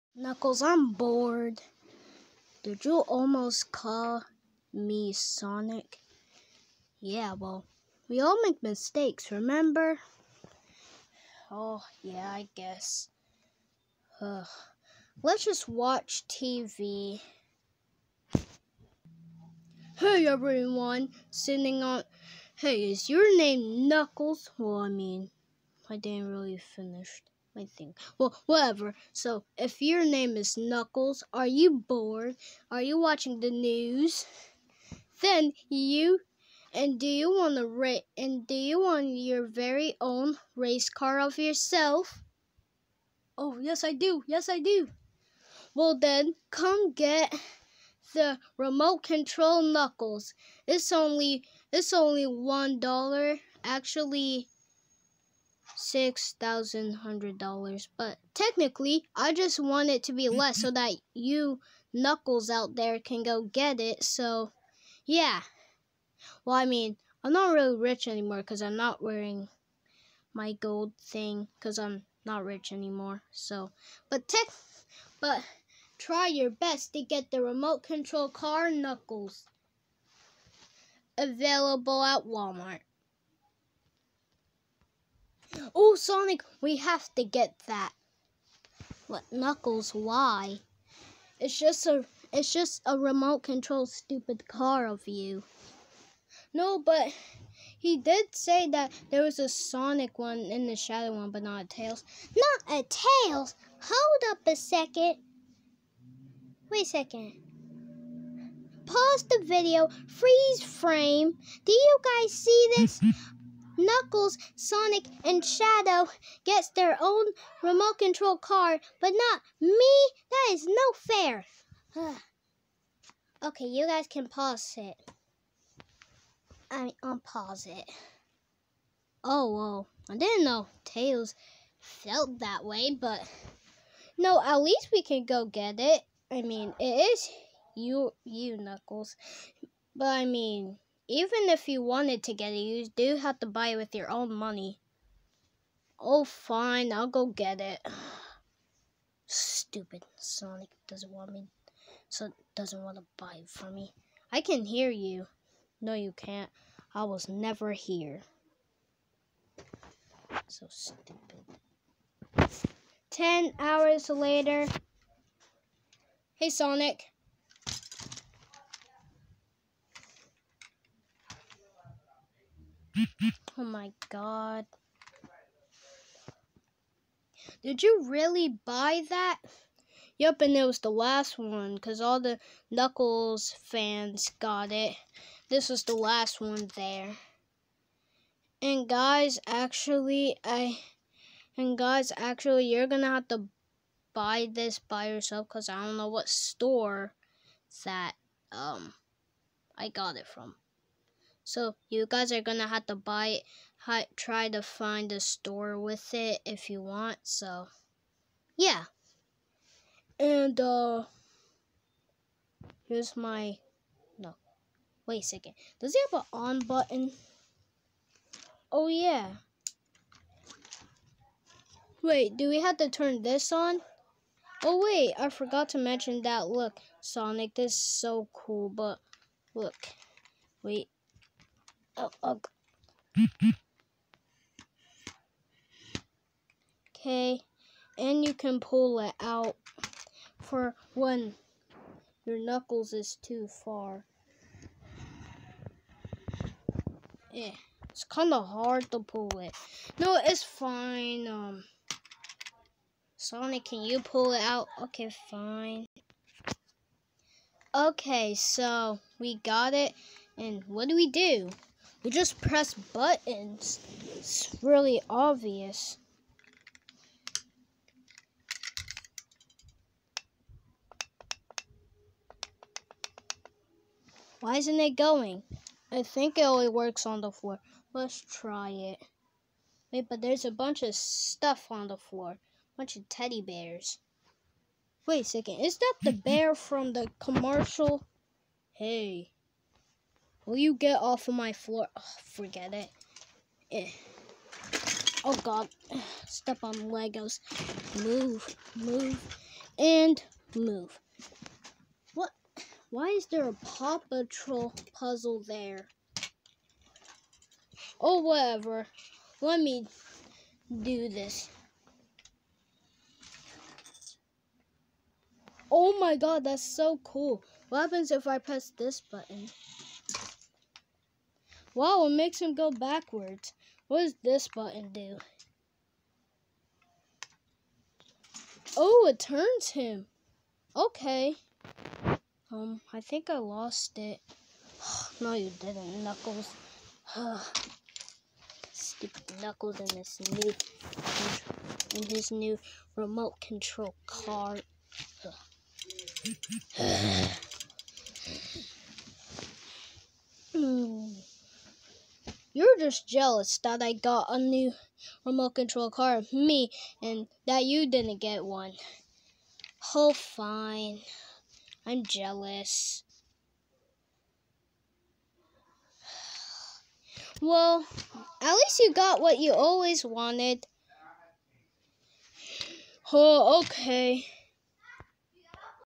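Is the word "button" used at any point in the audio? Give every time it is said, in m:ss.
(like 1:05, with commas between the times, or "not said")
3:36, 4:22, 5:19, 5:24.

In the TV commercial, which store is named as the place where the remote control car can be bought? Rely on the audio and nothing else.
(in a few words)
Walmart.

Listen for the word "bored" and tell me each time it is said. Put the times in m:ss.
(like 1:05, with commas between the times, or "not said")
0:00, 0:31.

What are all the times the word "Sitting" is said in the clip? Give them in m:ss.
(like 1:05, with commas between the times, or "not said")
0:21.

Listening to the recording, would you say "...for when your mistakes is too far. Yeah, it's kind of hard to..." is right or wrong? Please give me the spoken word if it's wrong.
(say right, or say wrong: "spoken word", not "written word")
wrong: "knuckles", not "mistakes".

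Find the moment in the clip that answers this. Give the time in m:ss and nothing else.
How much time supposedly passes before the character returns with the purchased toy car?
2:43.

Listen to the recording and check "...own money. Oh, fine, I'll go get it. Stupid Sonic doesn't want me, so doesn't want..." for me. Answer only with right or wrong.
right.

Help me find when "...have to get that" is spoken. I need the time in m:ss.
1:26.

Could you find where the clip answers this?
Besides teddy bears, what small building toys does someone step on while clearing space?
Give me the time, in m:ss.
4:56.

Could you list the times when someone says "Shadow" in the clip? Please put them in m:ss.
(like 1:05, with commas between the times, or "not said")
1:40, 1:55.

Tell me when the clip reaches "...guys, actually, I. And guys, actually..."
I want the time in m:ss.
3:08.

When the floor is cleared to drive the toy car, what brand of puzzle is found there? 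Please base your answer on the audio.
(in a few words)
Paw Patrol.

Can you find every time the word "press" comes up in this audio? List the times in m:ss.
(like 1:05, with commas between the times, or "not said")
4:22, 5:18.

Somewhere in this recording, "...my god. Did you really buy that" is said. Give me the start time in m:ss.
2:53.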